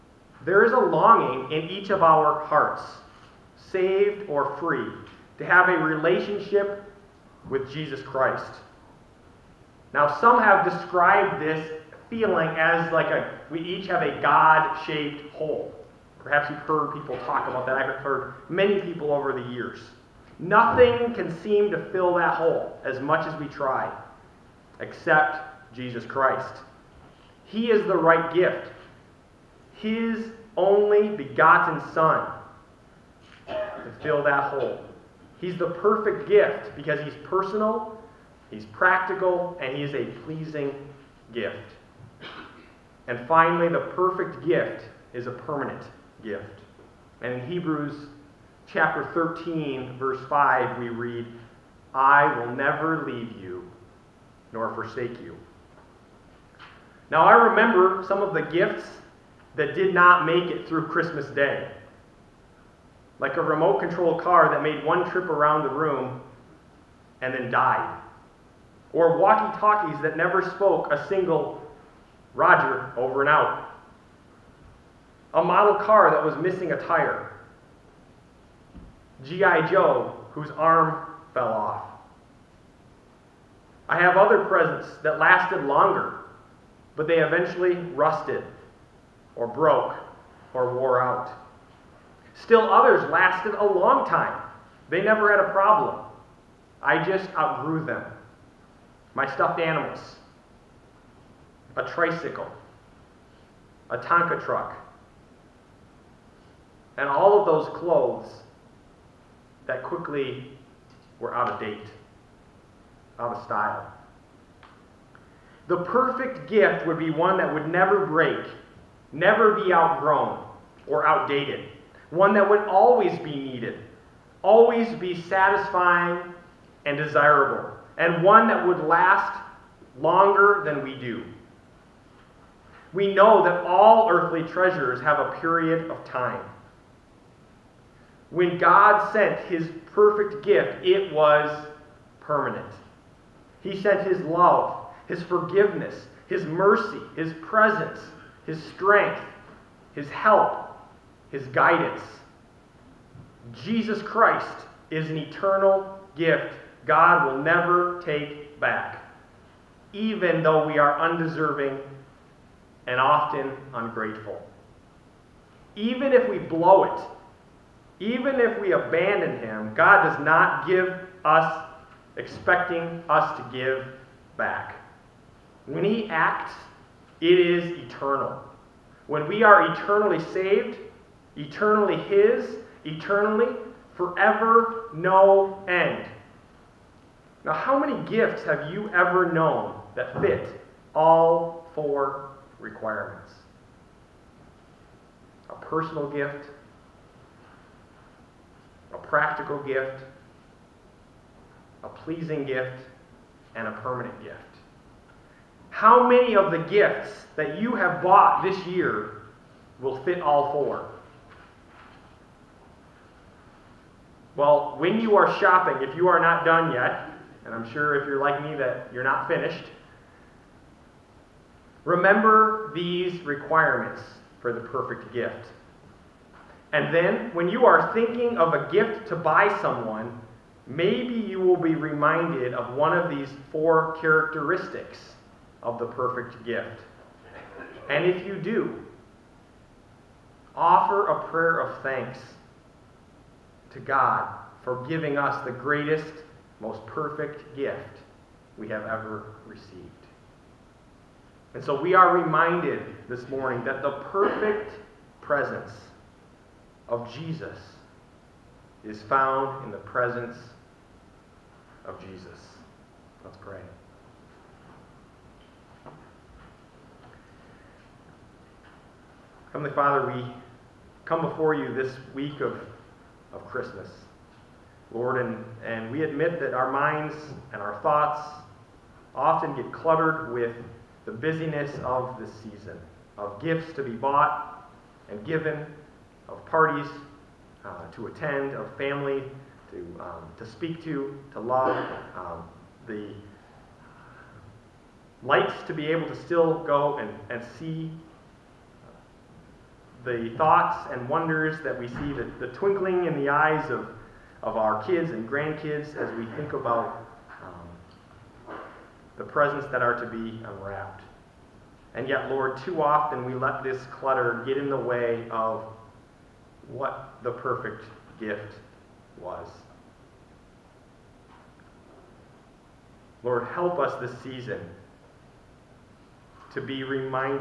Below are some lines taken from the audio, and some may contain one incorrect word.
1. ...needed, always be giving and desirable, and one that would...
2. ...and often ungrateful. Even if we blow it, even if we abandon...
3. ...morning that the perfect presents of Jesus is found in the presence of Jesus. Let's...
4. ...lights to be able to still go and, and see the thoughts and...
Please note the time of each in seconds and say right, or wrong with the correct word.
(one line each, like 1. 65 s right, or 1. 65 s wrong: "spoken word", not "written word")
1. 123 s wrong: "satisfying", not "giving"
2. 162 s right
3. 253 s right
4. 295 s right.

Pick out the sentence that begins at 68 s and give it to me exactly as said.
Or walkie talkies that never spoke a single Roger, over and out.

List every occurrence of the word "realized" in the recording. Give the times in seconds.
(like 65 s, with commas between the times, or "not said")
not said.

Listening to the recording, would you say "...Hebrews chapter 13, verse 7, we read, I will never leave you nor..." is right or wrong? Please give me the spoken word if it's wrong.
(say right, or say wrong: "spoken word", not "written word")
wrong: "5", not "7".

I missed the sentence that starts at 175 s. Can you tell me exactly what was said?
When He acts, it is eternal.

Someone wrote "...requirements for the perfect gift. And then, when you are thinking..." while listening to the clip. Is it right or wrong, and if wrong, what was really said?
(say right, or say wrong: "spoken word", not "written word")
right.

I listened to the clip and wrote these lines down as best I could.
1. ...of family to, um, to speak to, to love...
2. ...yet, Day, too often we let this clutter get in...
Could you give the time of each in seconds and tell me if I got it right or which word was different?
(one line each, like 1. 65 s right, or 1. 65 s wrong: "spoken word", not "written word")
1. 288 s right
2. 312 s wrong: "Lord", not "Day".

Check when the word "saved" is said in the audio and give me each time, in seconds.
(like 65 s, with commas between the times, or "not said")
3 s, 180 s.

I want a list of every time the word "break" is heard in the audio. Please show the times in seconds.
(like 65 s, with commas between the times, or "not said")
118 s.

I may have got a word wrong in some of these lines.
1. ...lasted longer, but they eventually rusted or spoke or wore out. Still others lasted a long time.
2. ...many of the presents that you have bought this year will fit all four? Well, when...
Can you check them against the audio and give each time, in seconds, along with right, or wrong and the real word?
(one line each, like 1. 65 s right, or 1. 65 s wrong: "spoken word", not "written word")
1. 85 s wrong: "broke", not "spoke"
2. 206 s wrong: "gifts", not "presents".